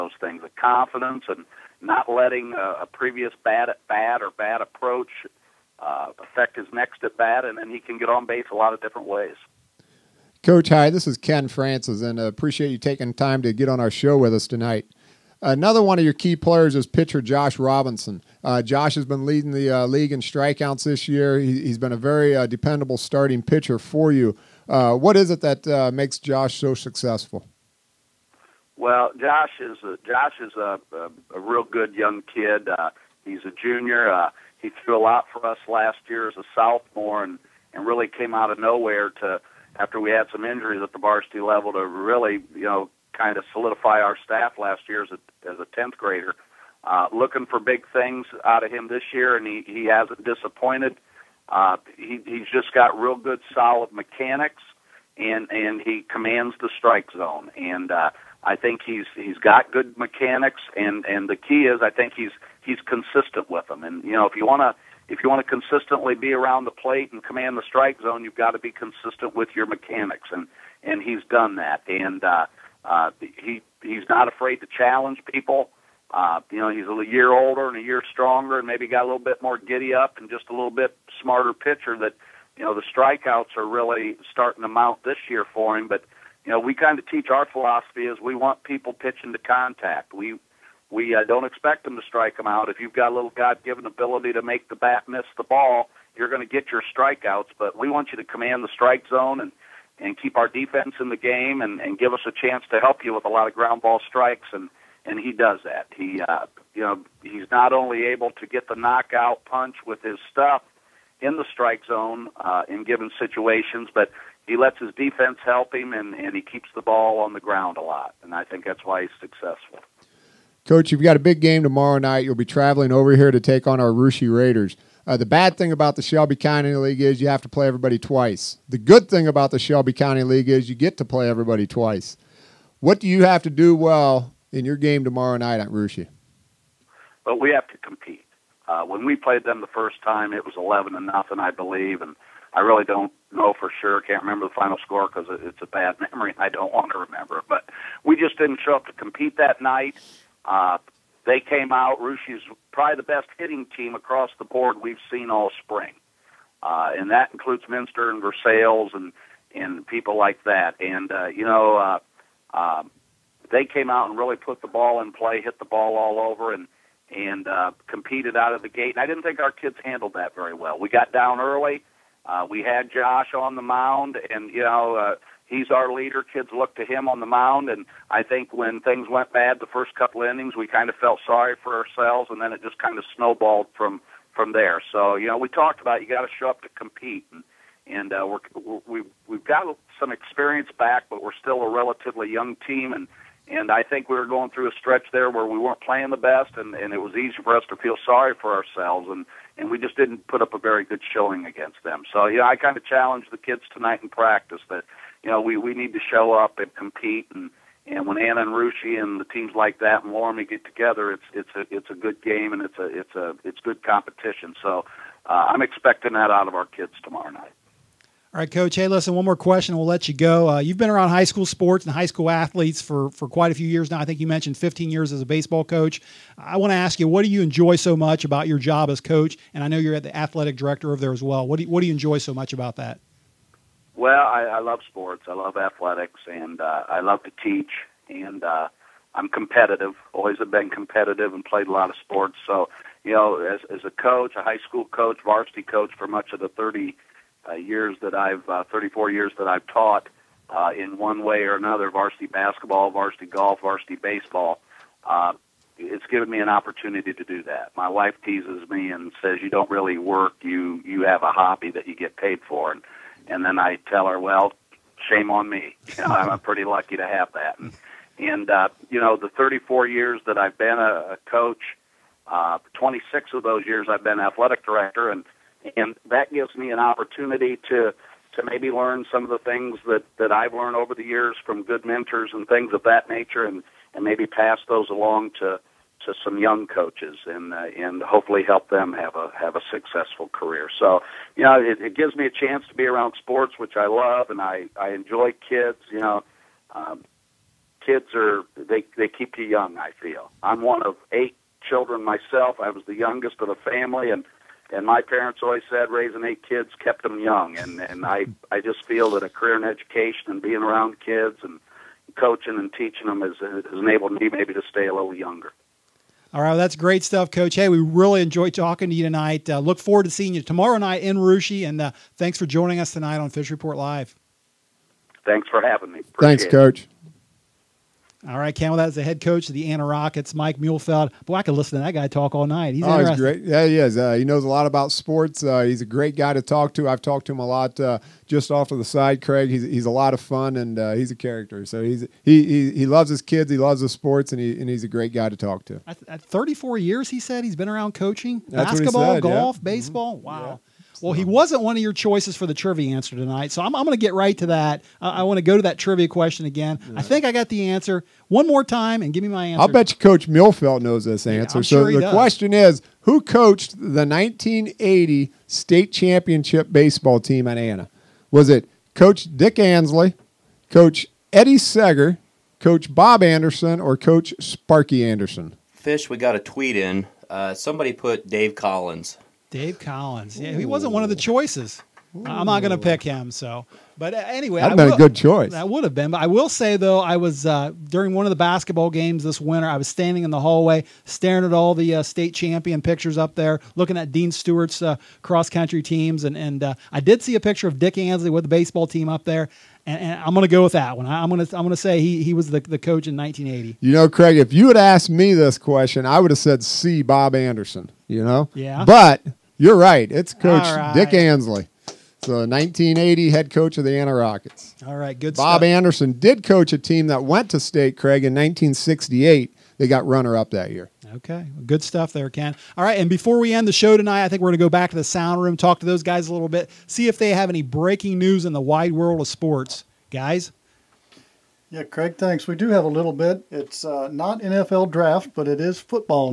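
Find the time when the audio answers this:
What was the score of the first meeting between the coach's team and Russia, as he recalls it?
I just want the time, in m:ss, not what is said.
2:20.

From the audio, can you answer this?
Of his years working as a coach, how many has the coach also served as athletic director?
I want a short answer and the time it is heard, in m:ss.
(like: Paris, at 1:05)
26, at 4:32.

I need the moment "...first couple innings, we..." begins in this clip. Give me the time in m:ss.
2:59.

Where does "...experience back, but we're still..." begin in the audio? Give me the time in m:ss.
3:10.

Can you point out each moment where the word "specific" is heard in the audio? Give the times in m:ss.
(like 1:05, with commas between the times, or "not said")
not said.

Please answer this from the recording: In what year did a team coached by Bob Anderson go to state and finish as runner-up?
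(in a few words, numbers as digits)
1968.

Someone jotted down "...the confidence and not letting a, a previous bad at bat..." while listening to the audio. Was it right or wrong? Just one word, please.
right.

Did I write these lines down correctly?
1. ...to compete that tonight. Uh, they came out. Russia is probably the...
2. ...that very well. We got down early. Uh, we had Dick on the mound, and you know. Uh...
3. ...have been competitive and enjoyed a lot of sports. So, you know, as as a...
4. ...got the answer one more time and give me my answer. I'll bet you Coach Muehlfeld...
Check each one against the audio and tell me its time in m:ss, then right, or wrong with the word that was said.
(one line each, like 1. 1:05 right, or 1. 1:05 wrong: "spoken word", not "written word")
1. 2:28 wrong: "night", not "tonight"
2. 2:50 wrong: "Josh", not "Dick"
3. 4:00 wrong: "played", not "enjoyed"
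4. 5:57 right.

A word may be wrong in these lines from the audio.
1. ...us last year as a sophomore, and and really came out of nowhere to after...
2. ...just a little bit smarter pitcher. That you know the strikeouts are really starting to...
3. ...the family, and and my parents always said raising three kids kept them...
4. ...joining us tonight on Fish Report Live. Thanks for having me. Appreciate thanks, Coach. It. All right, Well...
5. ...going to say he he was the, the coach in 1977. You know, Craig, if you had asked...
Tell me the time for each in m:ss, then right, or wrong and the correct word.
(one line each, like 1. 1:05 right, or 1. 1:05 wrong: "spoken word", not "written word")
1. 0:35 right
2. 1:20 right
3. 5:03 wrong: "eight", not "three"
4. 5:22 right
5. 6:41 wrong: "1980", not "1977".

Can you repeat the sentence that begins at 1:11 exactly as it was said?
And uh, uh, he he's not afraid to challenge people.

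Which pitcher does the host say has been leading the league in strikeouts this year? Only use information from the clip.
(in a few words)
Josh Robinson.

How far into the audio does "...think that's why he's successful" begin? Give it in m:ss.
1:58.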